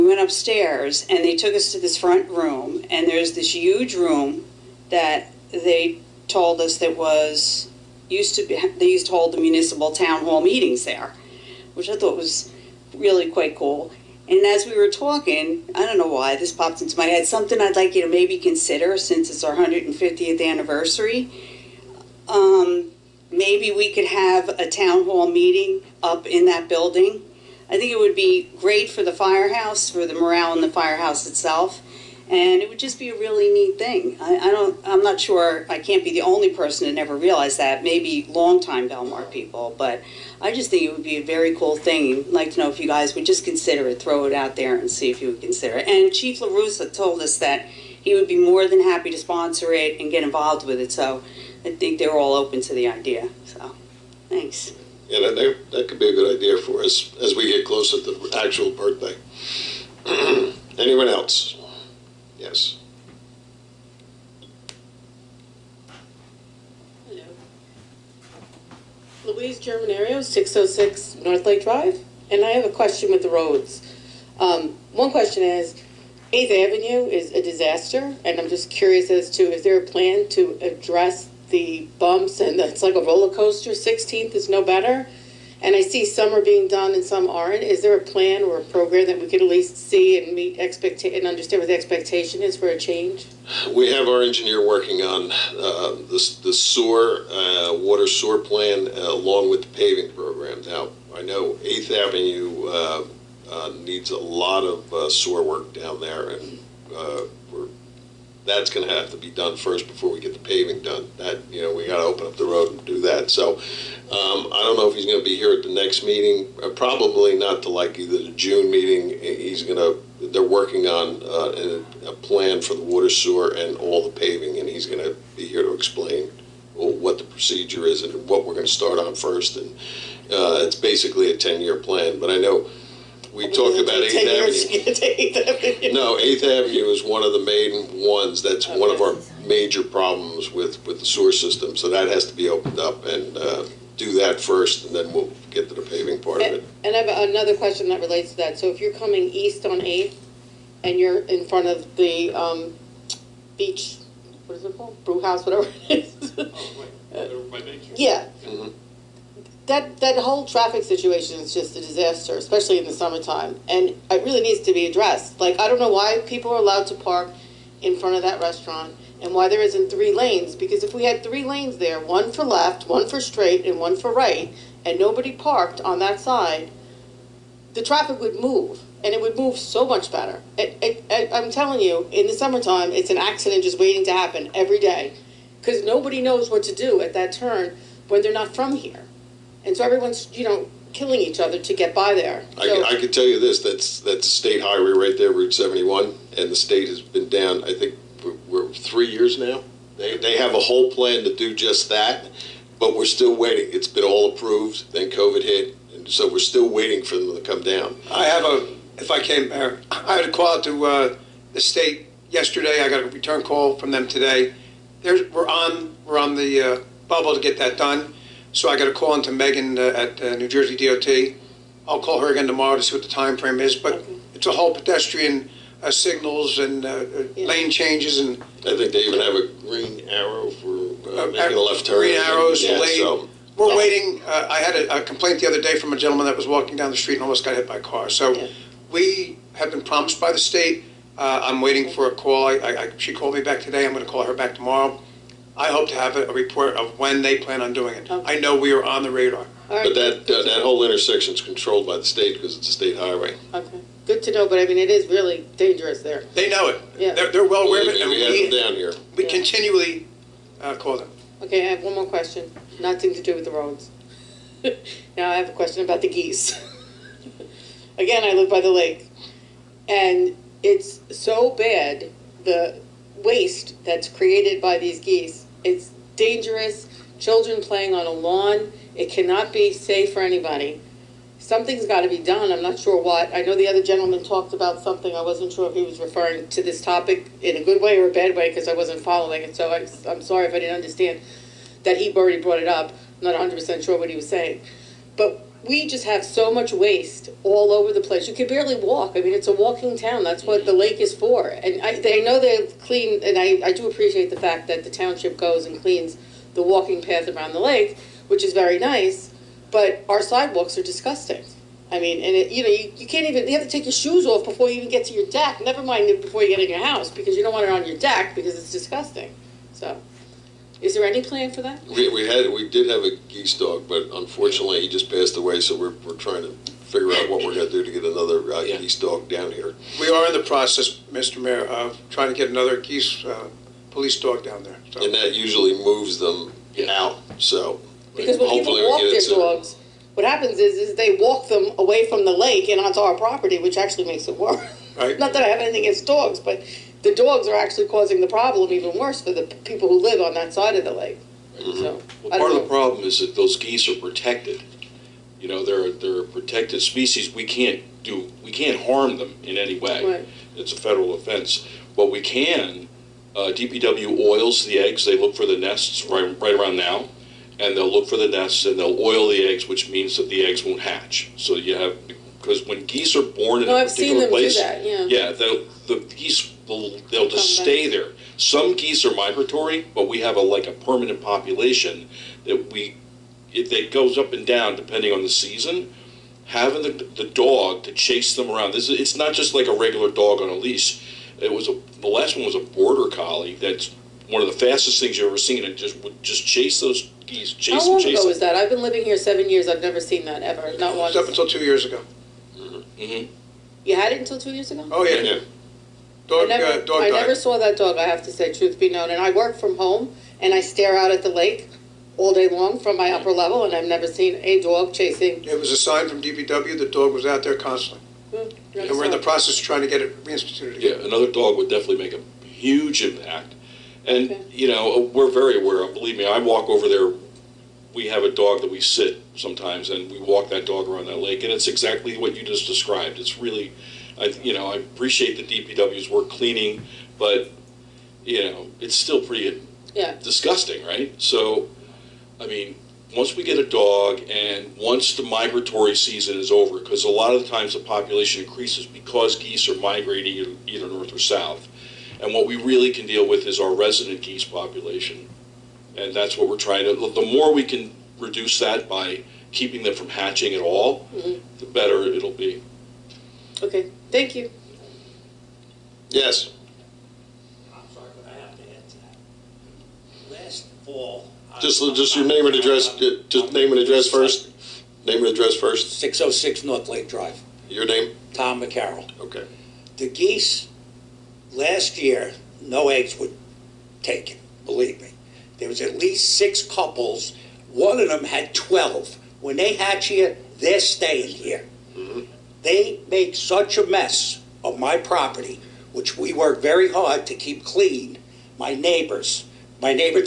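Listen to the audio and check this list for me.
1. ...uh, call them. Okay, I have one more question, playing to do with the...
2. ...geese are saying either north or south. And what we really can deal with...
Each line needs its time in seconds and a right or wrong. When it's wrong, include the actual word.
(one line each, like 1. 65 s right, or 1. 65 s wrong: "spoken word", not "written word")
1. 260 s wrong: "nothing", not "playing"
2. 449 s wrong: "migrating", not "saying".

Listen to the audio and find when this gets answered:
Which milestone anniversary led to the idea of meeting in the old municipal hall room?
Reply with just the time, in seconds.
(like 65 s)
19 s.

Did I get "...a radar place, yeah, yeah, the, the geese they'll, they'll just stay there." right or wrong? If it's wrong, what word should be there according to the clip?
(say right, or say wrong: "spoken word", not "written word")
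wrong: "particular", not "radar".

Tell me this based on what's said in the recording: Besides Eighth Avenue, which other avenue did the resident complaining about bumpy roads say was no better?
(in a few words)
16th.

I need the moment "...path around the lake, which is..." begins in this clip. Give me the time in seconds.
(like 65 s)
307 s.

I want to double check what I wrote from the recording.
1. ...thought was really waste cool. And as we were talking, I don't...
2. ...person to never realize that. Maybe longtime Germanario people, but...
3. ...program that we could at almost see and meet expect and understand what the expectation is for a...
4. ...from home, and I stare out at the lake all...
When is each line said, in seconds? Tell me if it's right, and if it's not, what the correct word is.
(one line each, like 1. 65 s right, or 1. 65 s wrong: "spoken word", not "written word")
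1. 11 s wrong: "quite", not "waste"
2. 36 s wrong: "Belmar", not "Germanario"
3. 88 s wrong: "least", not "almost"
4. 409 s right.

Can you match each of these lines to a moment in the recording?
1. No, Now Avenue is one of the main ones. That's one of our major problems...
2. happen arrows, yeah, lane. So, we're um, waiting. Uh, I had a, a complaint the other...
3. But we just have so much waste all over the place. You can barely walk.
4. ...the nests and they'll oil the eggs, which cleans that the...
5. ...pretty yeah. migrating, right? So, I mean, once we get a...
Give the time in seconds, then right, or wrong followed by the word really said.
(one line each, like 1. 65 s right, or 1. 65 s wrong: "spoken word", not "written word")
1. 135 s wrong: "Eighth", not "Now"
2. 231 s wrong: "green", not "happen"
3. 295 s right
4. 368 s wrong: "means", not "cleans"
5. 439 s wrong: "disgusting", not "migrating".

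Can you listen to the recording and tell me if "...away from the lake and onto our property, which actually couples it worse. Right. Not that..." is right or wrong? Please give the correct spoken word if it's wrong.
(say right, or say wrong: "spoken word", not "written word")
wrong: "makes", not "couples".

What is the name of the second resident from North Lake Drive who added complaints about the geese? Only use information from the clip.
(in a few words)
Tom McCarroll.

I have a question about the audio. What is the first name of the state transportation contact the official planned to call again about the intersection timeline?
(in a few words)
Megan.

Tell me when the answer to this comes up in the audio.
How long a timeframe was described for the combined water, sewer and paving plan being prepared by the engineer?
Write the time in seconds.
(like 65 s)
131 s.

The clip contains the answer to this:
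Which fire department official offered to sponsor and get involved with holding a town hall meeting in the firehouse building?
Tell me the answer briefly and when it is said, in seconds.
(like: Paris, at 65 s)
Chief Larusa, at 46 s.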